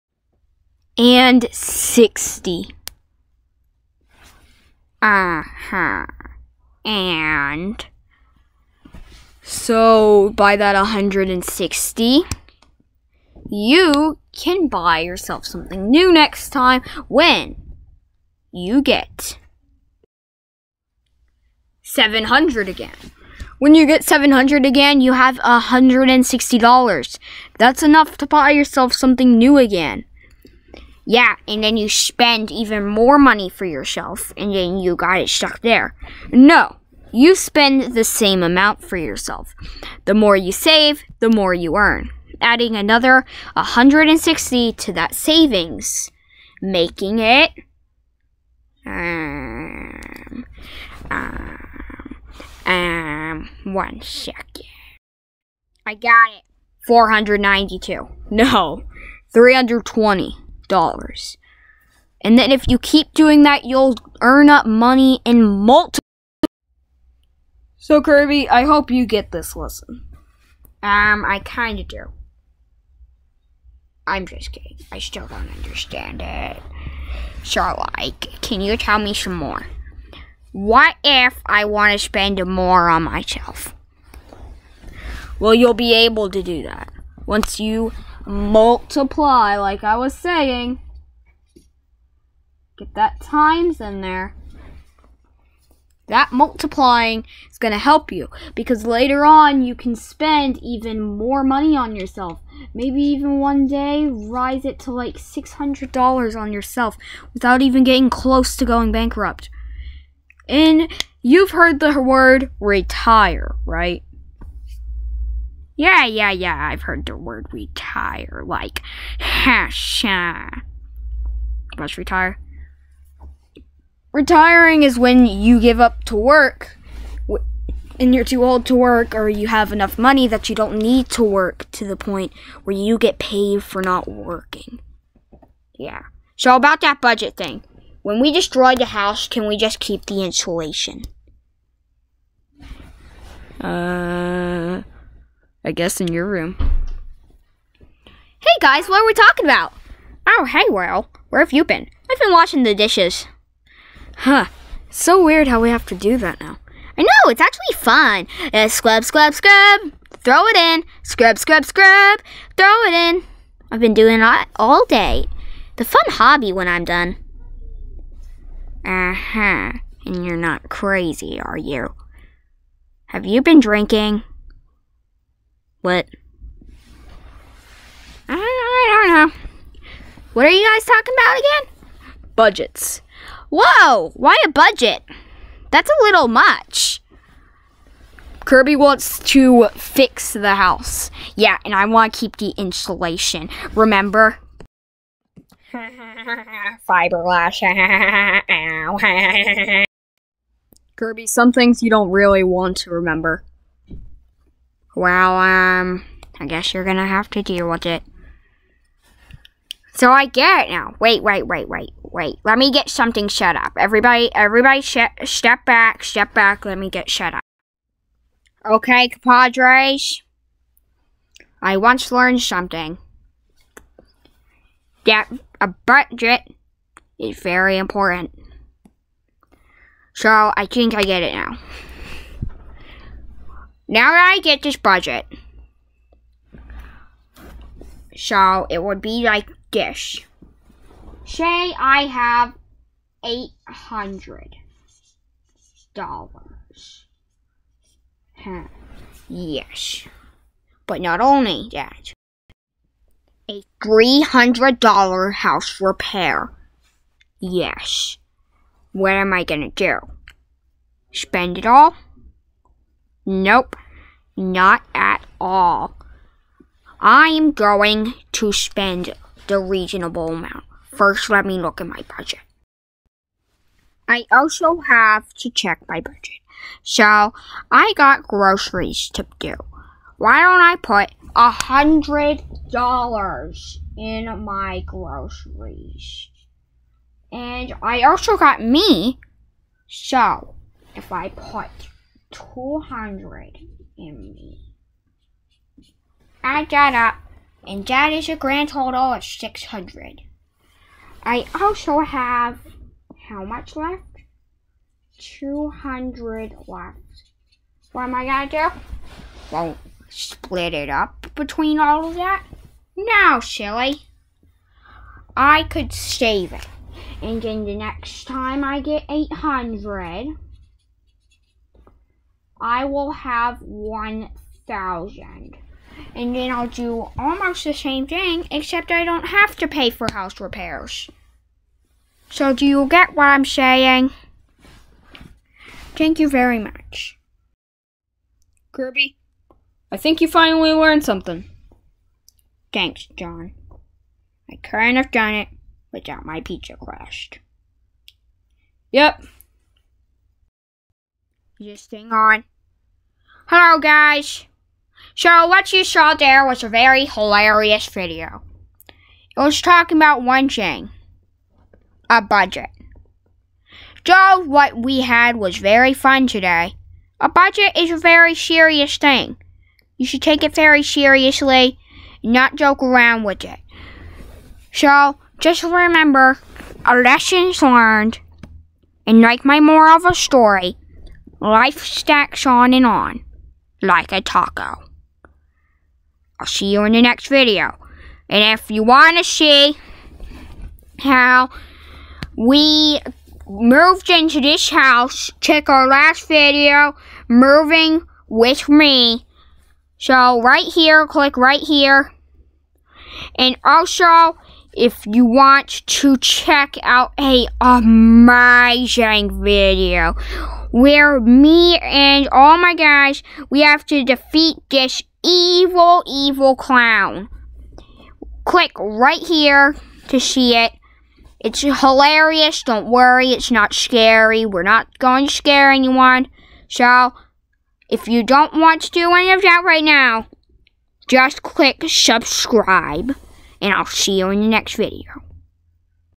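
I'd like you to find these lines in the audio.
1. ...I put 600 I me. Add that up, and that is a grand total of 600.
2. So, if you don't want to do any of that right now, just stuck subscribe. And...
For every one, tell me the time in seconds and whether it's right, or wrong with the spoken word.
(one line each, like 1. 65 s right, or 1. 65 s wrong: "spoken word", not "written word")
1. 291 s wrong: "200", not "600"
2. 426 s wrong: "click", not "stuck".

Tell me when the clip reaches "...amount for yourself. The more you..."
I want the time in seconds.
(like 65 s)
38 s.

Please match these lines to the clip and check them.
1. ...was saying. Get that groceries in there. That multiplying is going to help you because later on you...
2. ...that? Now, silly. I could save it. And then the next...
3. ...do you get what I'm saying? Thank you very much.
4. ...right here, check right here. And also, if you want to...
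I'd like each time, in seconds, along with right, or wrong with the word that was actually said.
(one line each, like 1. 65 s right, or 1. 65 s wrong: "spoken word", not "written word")
1. 89 s wrong: "times", not "groceries"
2. 312 s right
3. 332 s right
4. 400 s wrong: "click", not "check".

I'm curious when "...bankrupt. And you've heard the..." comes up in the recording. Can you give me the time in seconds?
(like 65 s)
108 s.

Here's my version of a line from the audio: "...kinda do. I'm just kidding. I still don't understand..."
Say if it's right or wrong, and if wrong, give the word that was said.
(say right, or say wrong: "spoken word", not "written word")
right.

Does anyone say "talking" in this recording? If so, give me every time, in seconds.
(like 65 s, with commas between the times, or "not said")
149 s, 180 s, 359 s.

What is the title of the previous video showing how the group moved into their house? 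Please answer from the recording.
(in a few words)
Moving with Me.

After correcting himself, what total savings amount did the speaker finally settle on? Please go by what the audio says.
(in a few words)
$320.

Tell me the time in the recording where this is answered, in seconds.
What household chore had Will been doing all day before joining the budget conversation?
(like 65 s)
152 s.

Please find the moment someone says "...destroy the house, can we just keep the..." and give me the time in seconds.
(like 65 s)
138 s.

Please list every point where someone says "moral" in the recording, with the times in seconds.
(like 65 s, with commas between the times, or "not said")
379 s.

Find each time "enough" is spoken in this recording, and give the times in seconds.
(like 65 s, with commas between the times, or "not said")
27 s, 129 s.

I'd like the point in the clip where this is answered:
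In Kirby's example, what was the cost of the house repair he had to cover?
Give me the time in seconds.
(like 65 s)
253 s.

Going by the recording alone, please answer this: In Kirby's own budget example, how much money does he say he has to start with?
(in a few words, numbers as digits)
$800.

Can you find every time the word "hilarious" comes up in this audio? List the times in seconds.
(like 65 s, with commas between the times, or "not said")
357 s, 421 s.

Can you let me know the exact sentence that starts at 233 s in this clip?
Now that I get this budget, so it would be like this.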